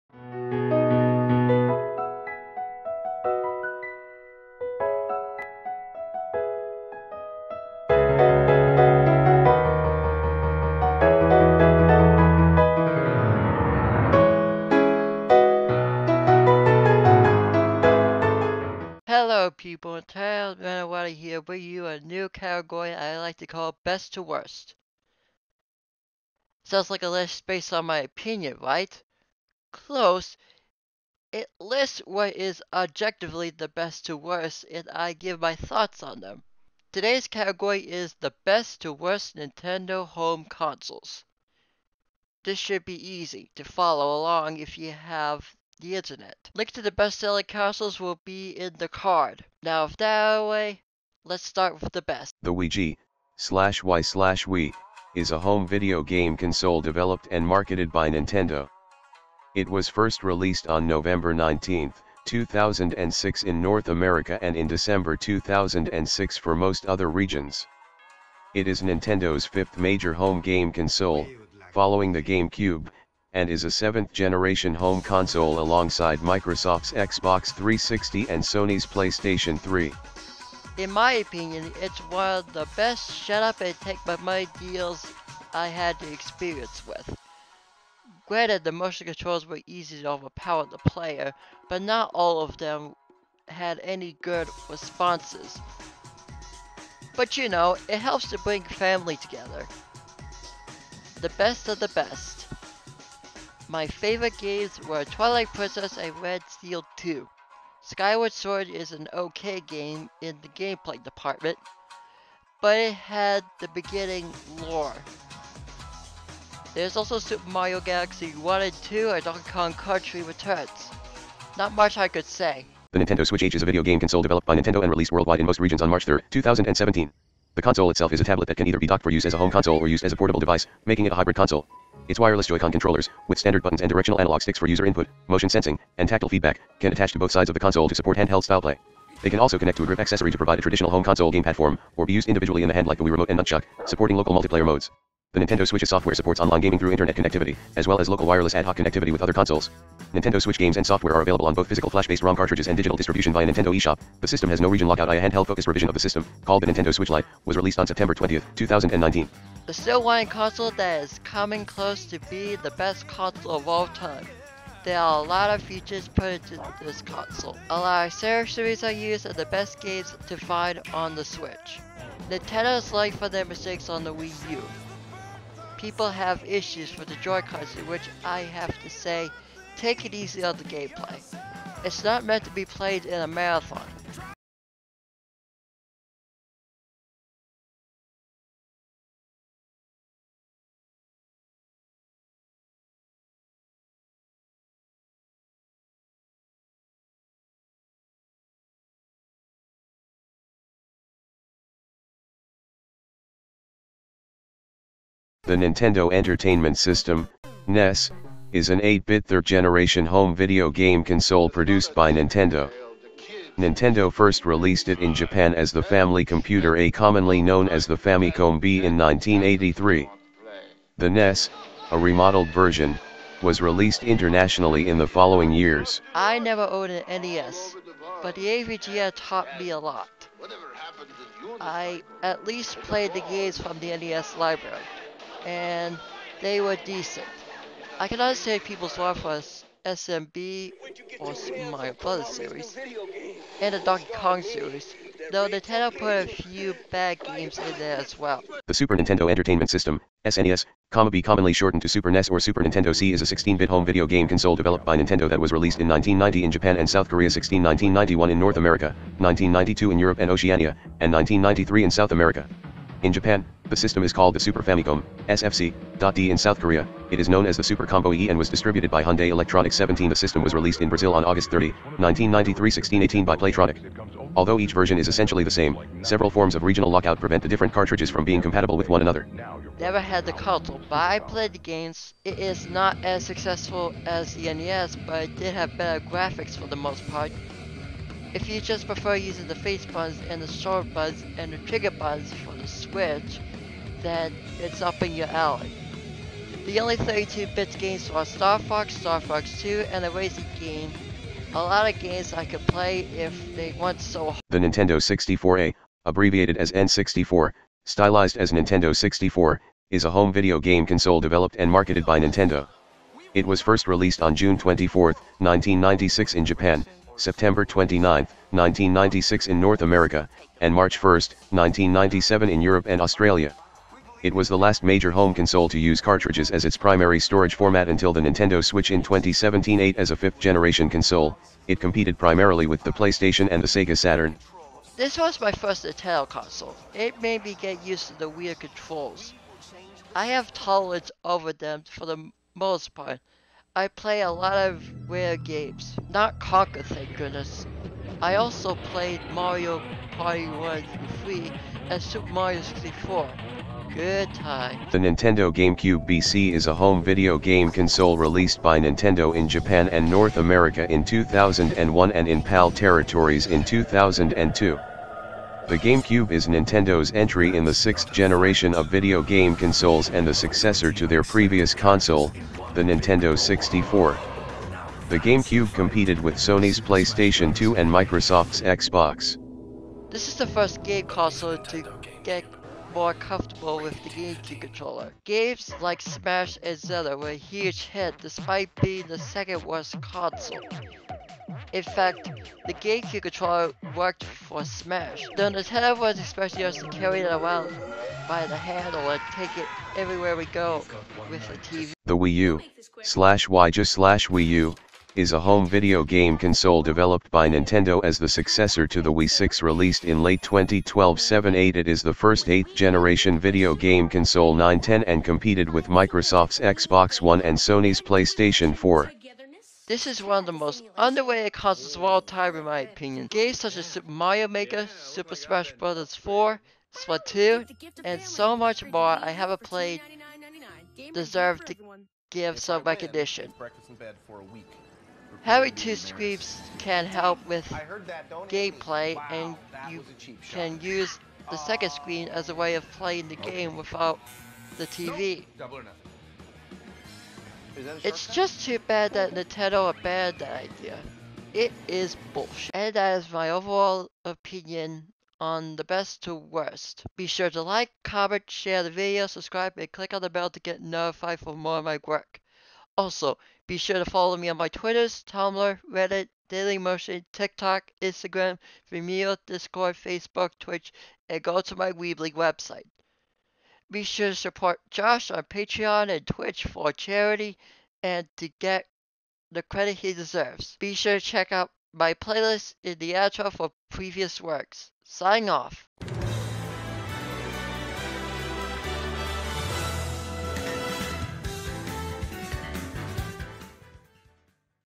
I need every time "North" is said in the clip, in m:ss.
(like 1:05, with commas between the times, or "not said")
1:03, 4:18, 5:19, 6:00.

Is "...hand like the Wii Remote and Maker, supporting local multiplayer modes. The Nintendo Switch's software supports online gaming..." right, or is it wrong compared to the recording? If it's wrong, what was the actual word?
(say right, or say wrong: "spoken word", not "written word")
wrong: "Nunchuk", not "Maker".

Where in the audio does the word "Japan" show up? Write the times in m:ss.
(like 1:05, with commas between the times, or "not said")
3:35, 4:16, 4:23, 5:16, 5:59.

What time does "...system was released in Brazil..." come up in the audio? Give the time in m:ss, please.
4:30.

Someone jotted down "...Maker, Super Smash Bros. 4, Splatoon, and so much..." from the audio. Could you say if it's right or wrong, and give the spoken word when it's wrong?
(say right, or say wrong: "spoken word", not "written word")
right.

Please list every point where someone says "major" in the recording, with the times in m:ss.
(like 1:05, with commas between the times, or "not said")
1:09, 5:24.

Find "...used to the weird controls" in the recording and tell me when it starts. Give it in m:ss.
5:37.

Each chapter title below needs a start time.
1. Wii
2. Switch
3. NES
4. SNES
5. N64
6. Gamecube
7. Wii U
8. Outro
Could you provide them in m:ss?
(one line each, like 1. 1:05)
1. 0:52
2. 2:02
3. 3:05
4. 4:09
5. 5:04
6. 5:55
7. 6:42
8. 7:33.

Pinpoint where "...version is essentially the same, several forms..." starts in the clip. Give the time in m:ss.
4:34.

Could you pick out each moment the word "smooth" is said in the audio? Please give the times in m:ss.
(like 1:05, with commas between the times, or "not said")
not said.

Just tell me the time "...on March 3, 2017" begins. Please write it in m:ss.
2:05.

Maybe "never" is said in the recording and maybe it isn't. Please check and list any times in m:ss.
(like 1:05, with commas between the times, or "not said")
3:46, 4:39.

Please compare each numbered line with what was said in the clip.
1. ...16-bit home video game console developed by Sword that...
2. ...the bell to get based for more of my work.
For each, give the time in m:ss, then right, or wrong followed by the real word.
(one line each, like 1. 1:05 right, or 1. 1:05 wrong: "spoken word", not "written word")
1. 4:13 wrong: "Nintendo", not "Sword"
2. 7:40 wrong: "notified", not "based".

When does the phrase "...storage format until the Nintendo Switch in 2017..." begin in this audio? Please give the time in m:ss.
5:27.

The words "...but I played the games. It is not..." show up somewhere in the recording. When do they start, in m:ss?
4:40.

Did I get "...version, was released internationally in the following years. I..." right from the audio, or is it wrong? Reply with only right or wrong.
right.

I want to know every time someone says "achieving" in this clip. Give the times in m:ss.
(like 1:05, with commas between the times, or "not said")
not said.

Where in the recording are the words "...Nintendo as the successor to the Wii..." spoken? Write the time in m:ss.
6:47.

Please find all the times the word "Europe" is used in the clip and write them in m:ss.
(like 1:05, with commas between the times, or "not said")
4:19, 5:22.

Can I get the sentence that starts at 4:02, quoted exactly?
series and the Donkey Kong series, though Nintendo put a few bad games in there as well.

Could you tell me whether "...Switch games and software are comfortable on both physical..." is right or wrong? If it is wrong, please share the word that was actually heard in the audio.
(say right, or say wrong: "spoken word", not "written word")
wrong: "available", not "comfortable".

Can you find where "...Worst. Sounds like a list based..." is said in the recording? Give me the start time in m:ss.
0:24.